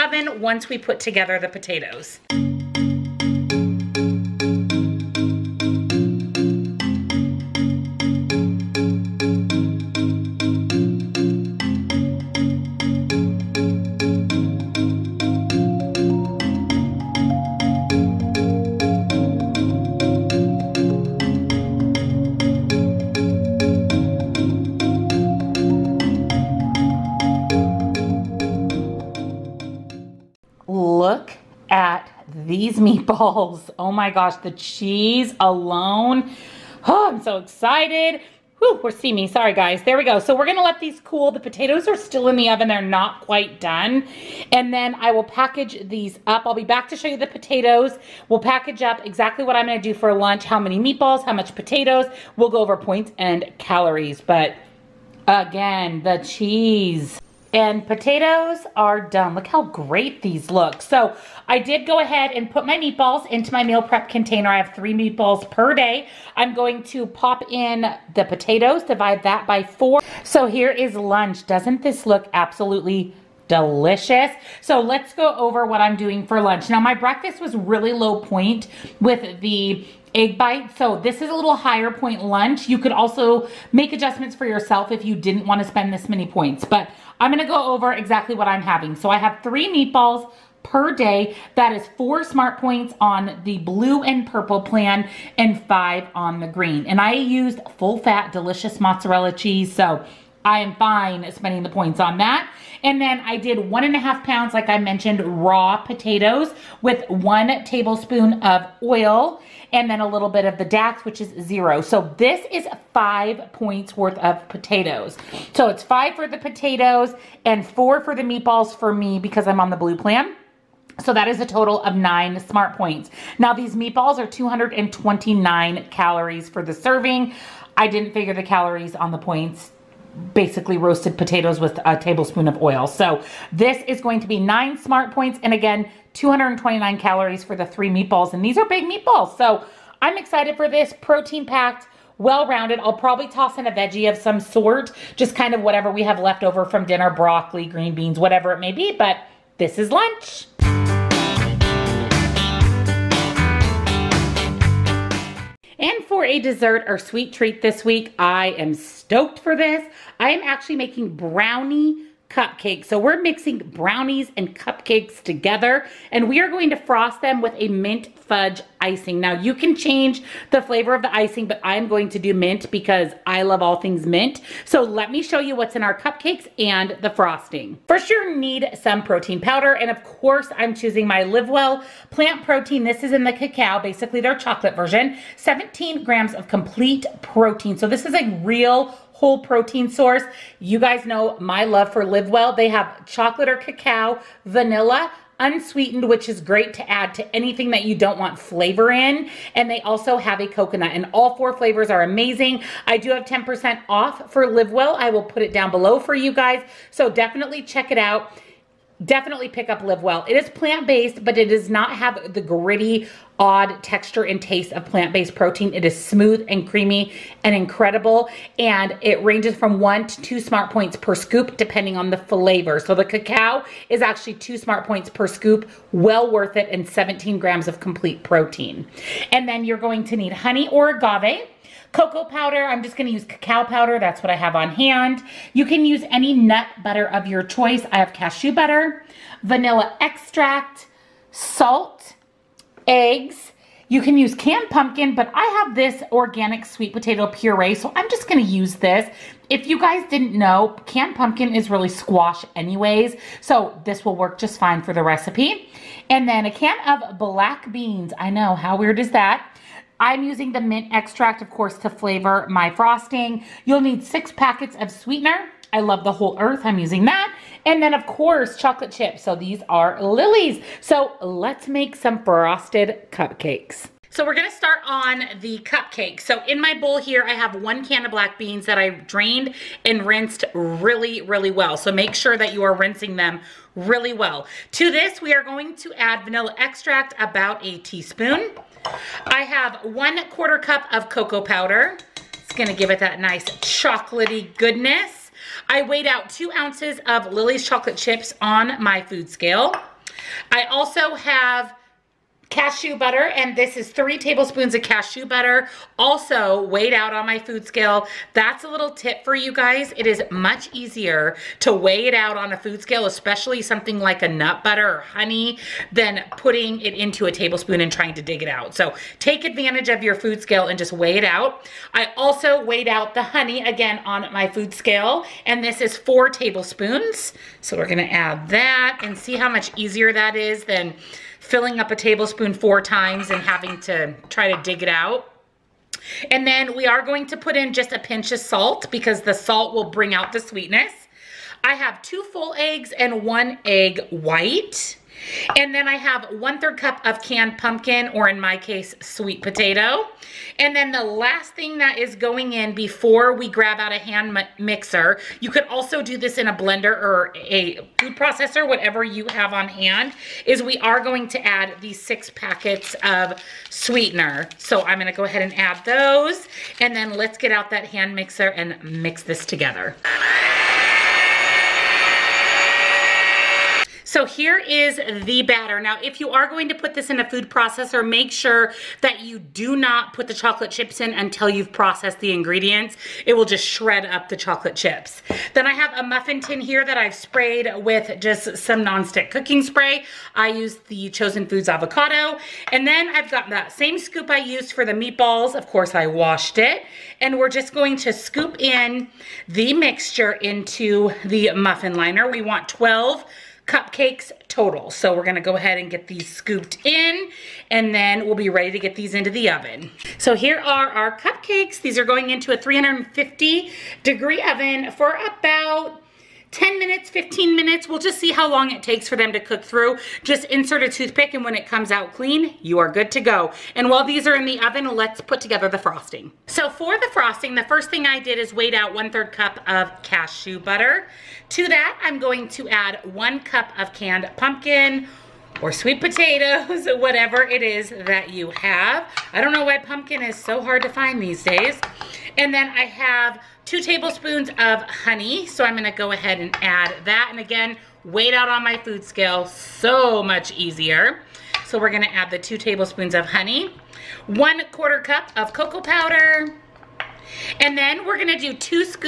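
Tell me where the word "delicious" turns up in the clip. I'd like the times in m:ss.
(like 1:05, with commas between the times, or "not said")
1:13, 1:38.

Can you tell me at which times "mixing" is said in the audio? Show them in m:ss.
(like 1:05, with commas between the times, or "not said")
2:43.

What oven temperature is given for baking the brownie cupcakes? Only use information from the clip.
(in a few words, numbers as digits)
350 degrees.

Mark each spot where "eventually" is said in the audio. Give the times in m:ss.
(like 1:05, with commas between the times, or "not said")
not said.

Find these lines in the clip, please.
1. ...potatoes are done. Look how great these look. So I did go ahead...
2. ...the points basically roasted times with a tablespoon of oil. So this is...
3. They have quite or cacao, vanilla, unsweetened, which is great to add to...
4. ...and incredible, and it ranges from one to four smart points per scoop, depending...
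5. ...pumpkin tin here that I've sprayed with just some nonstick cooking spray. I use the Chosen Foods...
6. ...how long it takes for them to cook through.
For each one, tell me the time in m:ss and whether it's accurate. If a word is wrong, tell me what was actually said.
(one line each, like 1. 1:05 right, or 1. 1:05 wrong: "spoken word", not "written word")
1. 0:57 right
2. 2:09 wrong: "potatoes", not "times"
3. 3:12 wrong: "chocolate", not "quite"
4. 3:37 wrong: "two", not "four"
5. 6:26 wrong: "muffin", not "pumpkin"
6. 6:58 right.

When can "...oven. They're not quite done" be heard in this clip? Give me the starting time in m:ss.
0:42.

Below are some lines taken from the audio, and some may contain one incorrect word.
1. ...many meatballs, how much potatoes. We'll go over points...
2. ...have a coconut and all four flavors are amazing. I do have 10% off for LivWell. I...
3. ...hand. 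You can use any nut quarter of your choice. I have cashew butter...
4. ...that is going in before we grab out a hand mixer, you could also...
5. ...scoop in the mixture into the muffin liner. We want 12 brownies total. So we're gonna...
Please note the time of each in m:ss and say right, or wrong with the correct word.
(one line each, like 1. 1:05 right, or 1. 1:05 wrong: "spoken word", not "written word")
1. 0:50 right
2. 3:20 right
3. 3:54 wrong: "butter", not "quarter"
4. 5:51 right
5. 6:38 wrong: "cupcakes", not "brownies".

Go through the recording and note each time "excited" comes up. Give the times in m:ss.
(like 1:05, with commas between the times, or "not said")
0:37, 2:20.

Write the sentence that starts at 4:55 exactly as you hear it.
I weighed out two ounces of Lily's chocolate chips on my food scale.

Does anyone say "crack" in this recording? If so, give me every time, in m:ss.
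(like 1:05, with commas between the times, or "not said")
not said.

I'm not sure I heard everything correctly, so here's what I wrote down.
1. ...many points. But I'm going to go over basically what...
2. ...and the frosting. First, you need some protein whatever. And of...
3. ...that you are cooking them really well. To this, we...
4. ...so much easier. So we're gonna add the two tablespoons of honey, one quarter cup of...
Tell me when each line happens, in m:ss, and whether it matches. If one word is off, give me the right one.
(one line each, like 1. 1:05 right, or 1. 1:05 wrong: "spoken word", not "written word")
1. 1:26 wrong: "exactly", not "basically"
2. 2:56 wrong: "powder", not "whatever"
3. 4:42 wrong: "rinsing", not "cooking"
4. 7:29 right.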